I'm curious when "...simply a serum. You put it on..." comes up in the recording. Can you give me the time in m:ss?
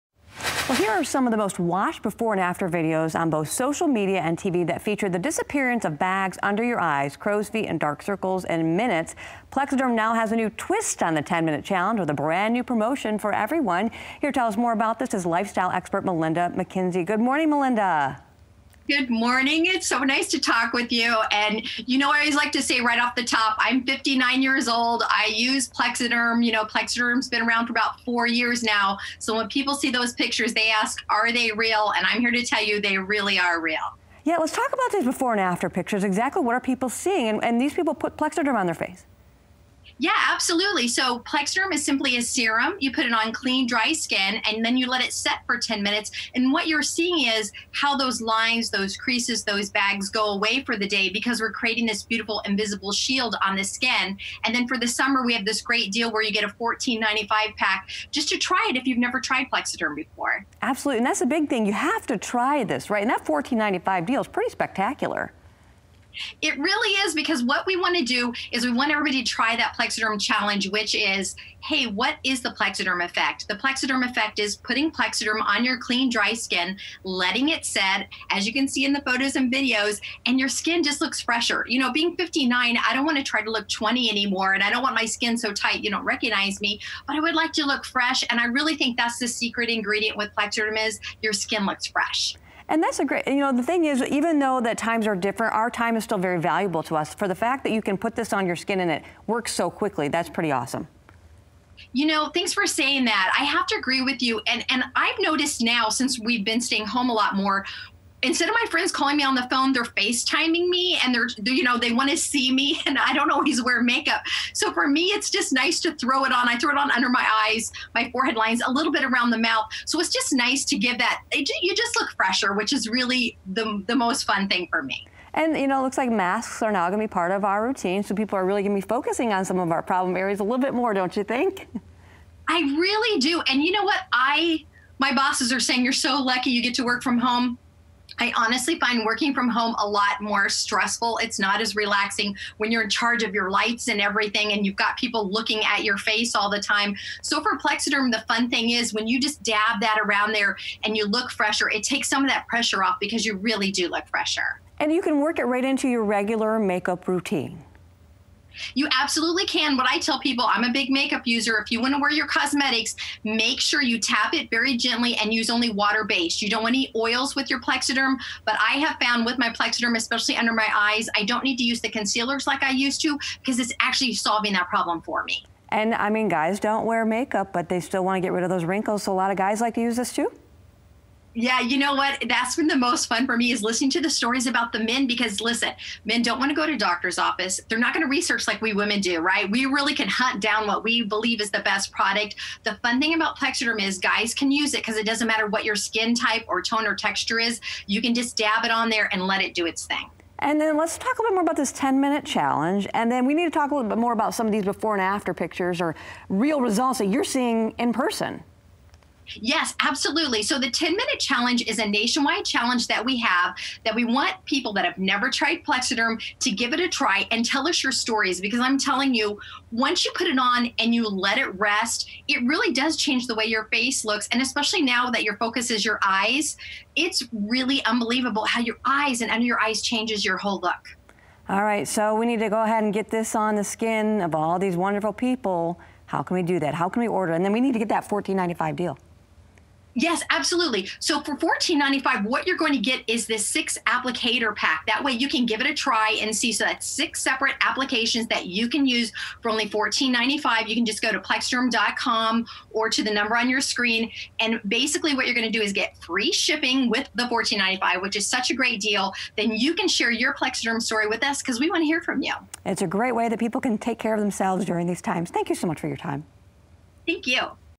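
0:41.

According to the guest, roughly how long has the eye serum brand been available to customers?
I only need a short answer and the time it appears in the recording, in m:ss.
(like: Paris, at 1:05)
about 4 years, at 0:27.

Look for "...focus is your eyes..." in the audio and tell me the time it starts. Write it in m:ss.
3:45.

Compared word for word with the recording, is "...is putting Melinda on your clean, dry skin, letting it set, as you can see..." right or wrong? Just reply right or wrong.
wrong.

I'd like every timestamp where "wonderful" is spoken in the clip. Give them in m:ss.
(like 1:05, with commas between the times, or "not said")
3:54.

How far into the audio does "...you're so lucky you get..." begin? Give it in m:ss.
2:15.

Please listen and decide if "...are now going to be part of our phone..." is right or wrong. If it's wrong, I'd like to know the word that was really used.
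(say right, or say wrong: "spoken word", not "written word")
wrong: "routine", not "phone".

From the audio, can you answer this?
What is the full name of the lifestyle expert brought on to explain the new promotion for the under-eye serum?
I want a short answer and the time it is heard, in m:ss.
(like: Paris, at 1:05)
Melinda McKinsey, at 0:16.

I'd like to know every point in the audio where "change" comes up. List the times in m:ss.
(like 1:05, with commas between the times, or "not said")
3:42, 3:49.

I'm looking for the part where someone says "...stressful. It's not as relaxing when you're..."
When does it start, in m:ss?
2:20.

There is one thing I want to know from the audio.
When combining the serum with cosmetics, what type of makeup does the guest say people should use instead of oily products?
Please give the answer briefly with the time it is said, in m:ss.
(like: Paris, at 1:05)
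water based, at 2:45.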